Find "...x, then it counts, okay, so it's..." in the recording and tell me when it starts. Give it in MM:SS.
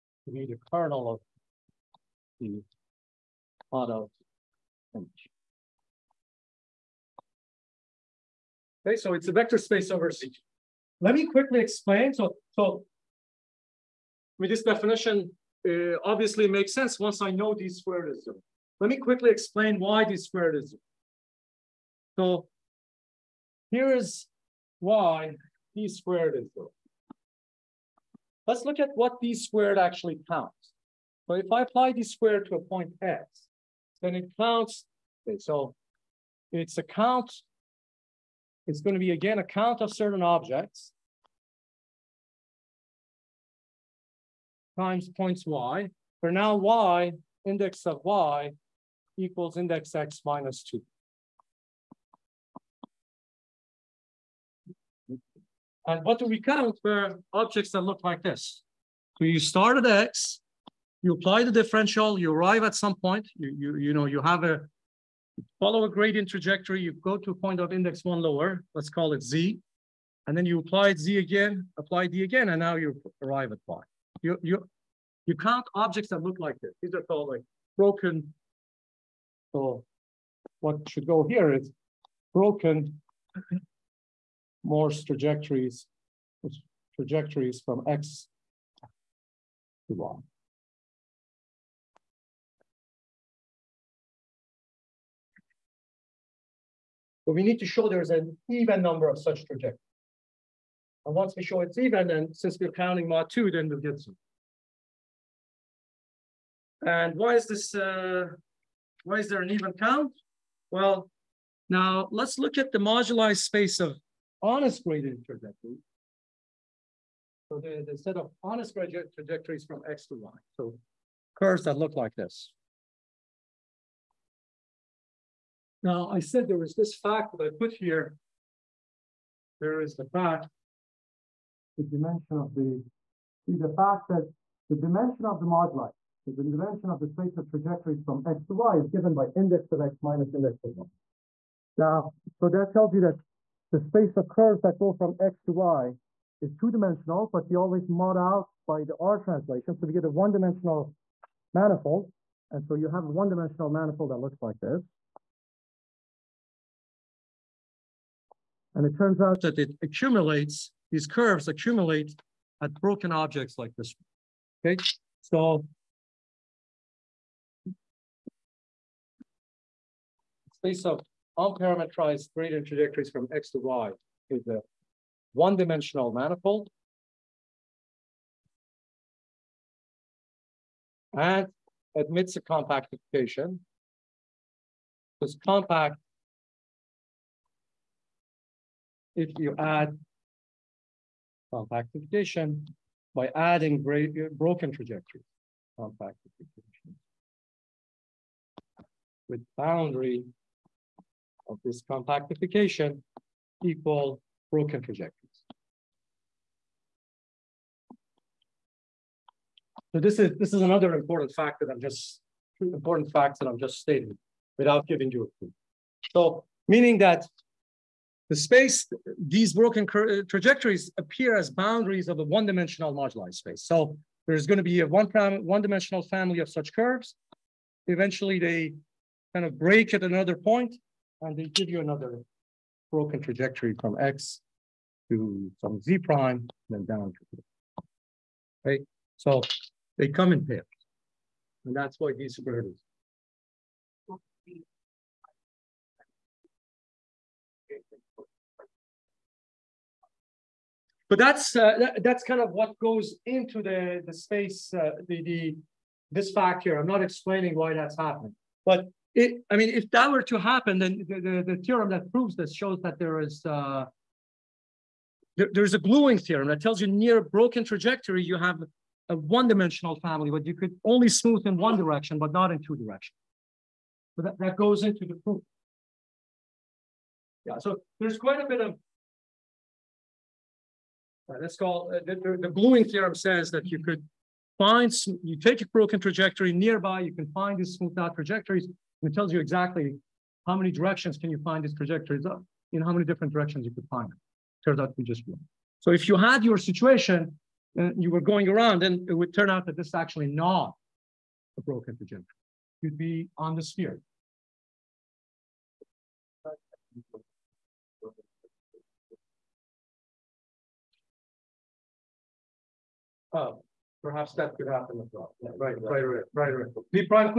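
00:33.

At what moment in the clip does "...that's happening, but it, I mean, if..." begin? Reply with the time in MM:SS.
04:17.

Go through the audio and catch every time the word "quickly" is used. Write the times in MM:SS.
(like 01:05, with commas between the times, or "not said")
00:11, 00:18.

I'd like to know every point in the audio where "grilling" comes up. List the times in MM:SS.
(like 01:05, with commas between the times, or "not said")
not said.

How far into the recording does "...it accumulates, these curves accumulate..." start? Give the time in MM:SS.
02:39.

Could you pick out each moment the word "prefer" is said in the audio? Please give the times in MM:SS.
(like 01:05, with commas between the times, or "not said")
not said.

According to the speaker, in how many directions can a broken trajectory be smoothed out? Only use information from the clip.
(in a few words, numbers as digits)
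1.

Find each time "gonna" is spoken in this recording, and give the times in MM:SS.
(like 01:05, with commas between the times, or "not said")
00:38.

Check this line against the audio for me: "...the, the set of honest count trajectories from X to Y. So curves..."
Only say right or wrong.
wrong.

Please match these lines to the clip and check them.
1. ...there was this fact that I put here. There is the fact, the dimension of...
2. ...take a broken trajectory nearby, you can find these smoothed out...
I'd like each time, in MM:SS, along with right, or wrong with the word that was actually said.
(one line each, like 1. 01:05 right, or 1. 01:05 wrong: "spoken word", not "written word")
1. 02:06 right
2. 04:45 right.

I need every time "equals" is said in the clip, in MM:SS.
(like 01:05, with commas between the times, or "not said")
00:49, 03:23.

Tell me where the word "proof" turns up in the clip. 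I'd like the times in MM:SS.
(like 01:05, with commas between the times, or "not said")
04:35.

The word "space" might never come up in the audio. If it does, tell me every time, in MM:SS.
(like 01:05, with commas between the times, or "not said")
00:09, 01:53, 02:17, 02:23, 02:50, 03:38, 03:43, 04:14.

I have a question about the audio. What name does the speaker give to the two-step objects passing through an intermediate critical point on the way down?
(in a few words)
broken Morse trajectories.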